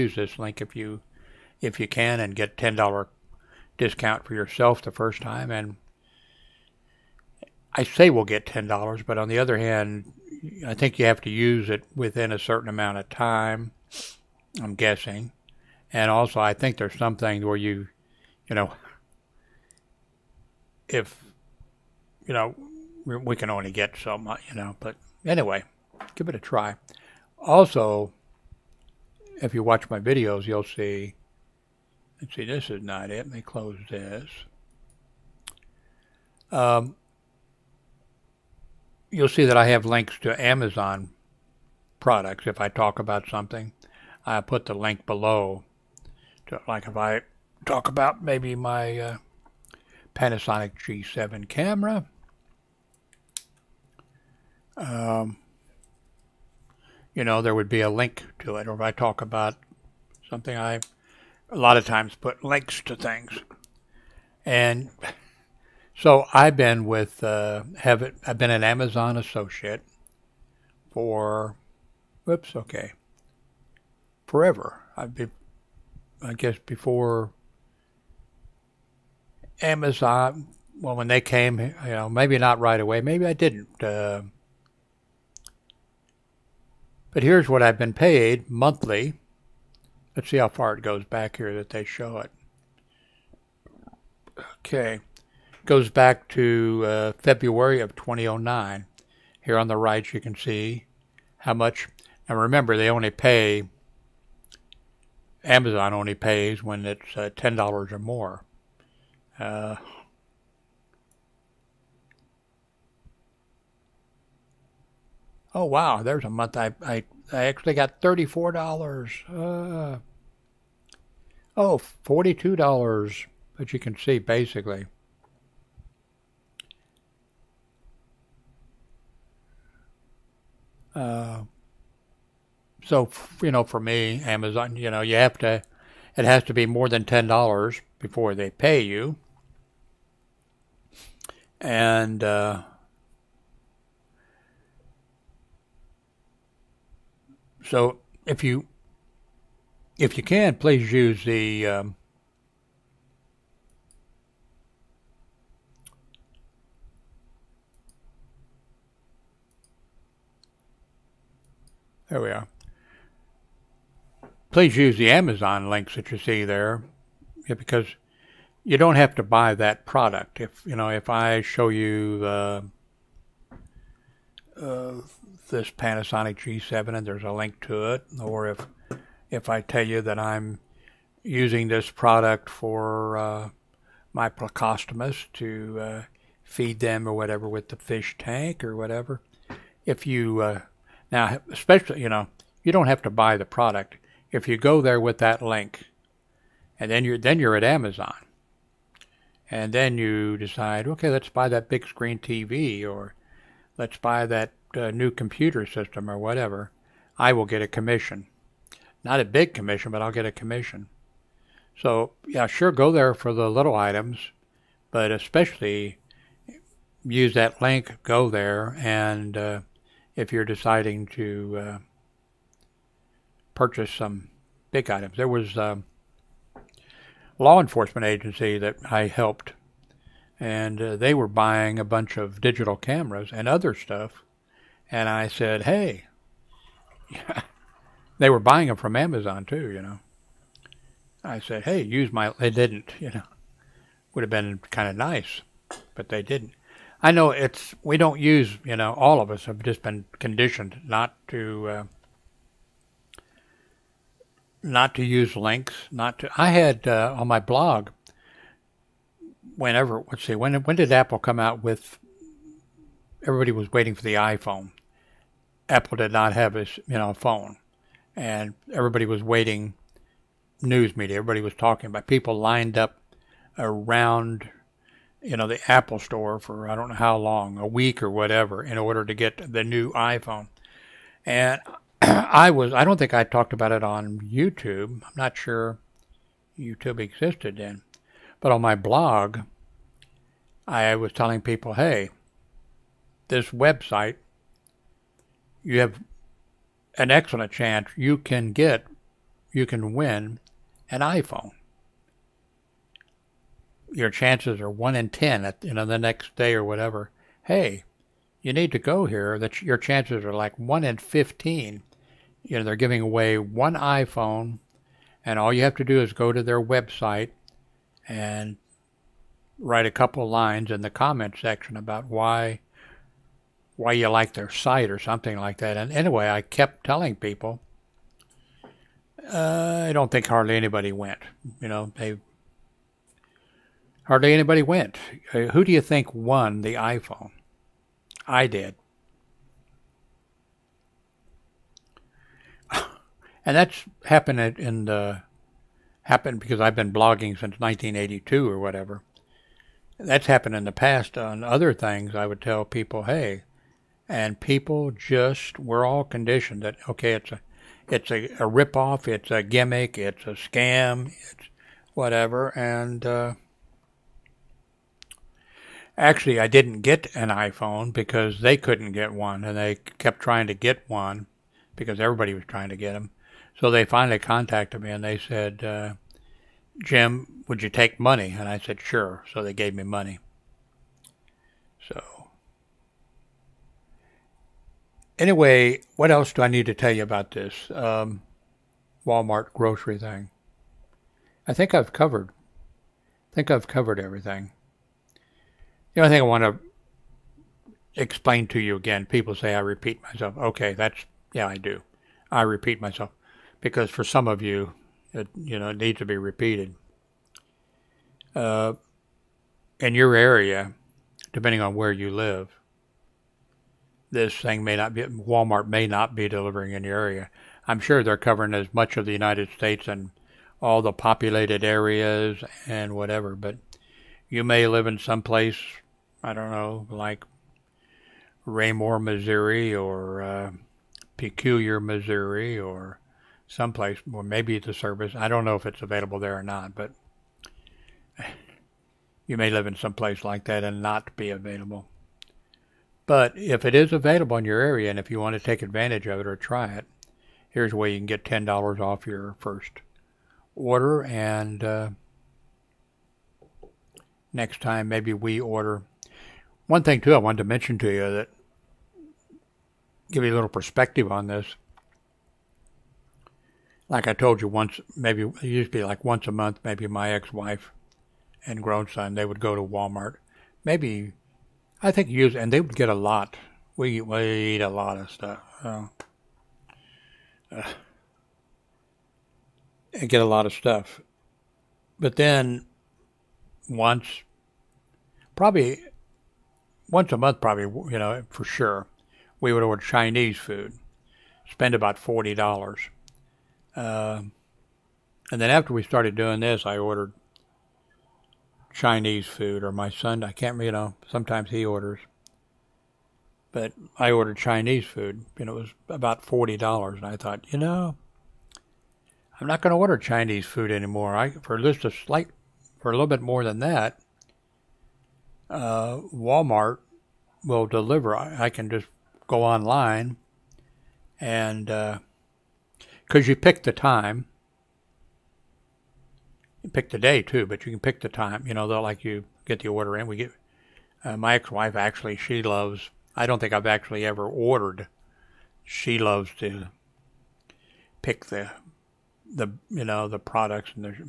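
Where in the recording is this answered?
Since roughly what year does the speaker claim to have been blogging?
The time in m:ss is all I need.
5:47.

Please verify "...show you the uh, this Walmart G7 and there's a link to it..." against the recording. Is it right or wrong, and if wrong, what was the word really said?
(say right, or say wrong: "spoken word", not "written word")
wrong: "Panasonic", not "Walmart".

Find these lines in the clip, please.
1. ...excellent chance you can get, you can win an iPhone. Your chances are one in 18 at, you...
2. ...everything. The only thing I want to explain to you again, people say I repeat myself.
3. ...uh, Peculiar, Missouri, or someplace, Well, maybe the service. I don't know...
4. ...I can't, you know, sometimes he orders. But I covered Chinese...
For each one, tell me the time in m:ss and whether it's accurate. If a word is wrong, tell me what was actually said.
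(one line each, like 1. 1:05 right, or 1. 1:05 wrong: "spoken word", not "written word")
1. 4:57 wrong: "10", not "18"
2. 6:33 right
3. 7:10 right
4. 8:20 wrong: "ordered", not "covered".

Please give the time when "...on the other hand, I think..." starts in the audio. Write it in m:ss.
0:09.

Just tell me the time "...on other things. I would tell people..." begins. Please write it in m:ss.
5:51.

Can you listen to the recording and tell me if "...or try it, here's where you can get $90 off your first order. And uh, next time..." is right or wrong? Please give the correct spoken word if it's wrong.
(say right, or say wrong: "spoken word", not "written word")
wrong: "10", not "90".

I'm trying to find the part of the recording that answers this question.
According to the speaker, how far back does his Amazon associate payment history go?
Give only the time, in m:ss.
1:37.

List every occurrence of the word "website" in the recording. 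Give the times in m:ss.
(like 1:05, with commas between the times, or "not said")
4:53, 5:16.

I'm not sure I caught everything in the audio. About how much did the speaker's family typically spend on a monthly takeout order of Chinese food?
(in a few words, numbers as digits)
$40.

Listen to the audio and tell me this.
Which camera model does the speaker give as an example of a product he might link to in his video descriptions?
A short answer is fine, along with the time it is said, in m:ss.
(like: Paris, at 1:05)
Panasonic G7, at 0:50.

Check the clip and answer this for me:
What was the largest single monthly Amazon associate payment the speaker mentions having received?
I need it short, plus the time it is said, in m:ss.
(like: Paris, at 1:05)
$42, at 2:02.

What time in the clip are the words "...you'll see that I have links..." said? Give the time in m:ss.
0:39.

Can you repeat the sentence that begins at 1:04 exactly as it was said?
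And so I've been with, uh, have it, I've been an Amazon associate for, whoops, okay, forever.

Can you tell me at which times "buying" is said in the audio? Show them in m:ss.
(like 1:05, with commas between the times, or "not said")
3:51, 3:58.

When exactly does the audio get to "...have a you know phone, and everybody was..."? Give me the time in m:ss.
4:26.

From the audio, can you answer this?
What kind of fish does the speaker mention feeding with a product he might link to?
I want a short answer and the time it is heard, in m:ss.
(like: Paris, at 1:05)
plecostomus, at 3:04.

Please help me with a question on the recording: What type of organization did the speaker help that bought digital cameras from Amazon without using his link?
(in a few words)
law enforcement agency.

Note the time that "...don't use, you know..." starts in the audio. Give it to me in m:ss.
4:07.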